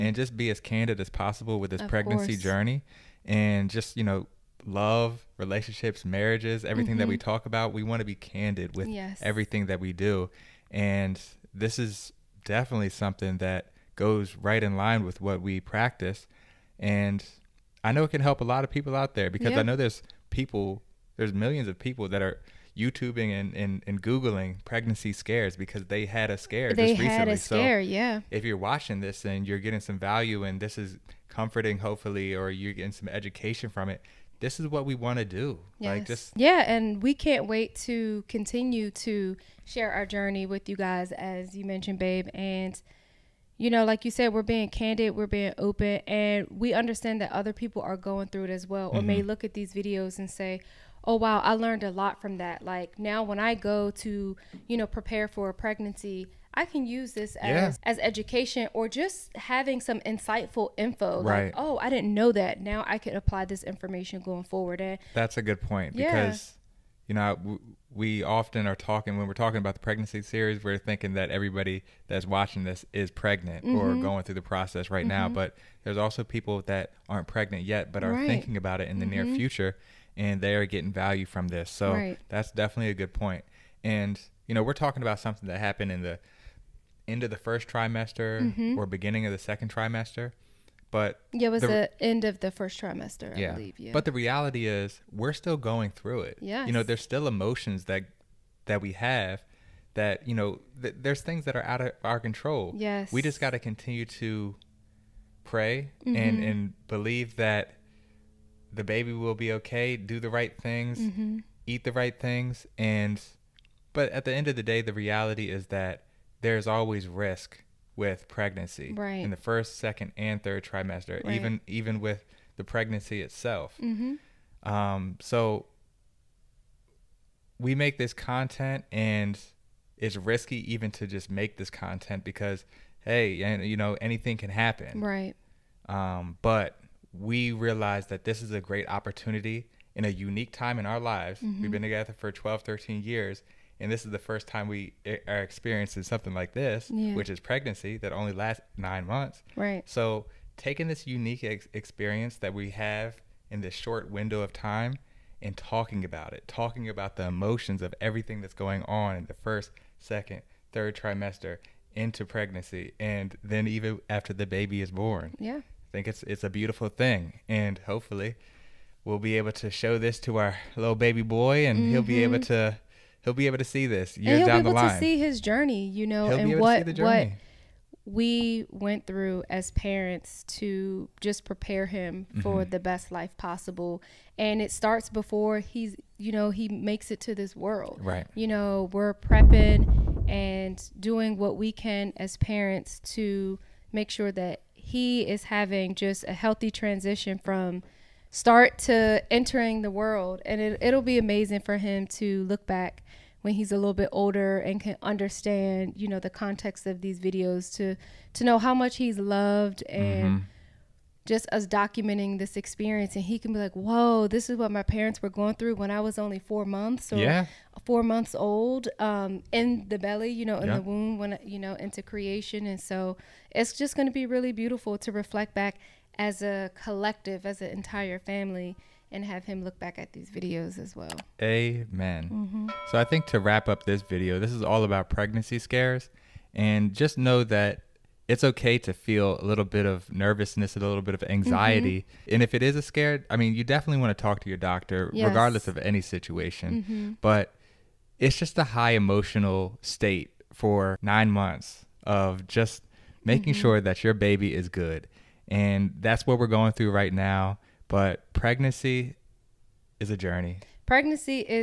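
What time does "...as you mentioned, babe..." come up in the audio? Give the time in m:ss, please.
0:41.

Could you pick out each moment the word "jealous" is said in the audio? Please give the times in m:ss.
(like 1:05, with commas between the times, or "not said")
not said.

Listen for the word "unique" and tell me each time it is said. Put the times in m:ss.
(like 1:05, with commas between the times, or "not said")
2:20, 2:31.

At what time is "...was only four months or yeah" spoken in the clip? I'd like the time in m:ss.
3:36.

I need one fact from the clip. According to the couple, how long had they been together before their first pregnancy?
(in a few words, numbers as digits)
12, 13 years.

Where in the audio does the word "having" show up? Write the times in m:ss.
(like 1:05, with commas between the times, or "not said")
0:59, 3:15.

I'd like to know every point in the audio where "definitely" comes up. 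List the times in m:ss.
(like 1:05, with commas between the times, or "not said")
0:12, 1:22, 4:03.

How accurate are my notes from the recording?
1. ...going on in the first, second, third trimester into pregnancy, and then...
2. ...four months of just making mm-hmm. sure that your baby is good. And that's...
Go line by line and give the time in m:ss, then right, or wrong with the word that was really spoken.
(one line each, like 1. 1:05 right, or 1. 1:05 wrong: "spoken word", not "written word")
1. 2:38 right
2. 4:11 wrong: "nine", not "four".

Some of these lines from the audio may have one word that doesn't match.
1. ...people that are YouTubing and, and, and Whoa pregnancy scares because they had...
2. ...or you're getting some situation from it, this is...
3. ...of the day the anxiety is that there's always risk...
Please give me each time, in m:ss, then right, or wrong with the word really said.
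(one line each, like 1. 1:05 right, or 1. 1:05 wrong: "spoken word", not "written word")
1. 0:21 wrong: "Googling", not "Whoa"
2. 0:32 wrong: "education", not "situation"
3. 1:54 wrong: "reality", not "anxiety".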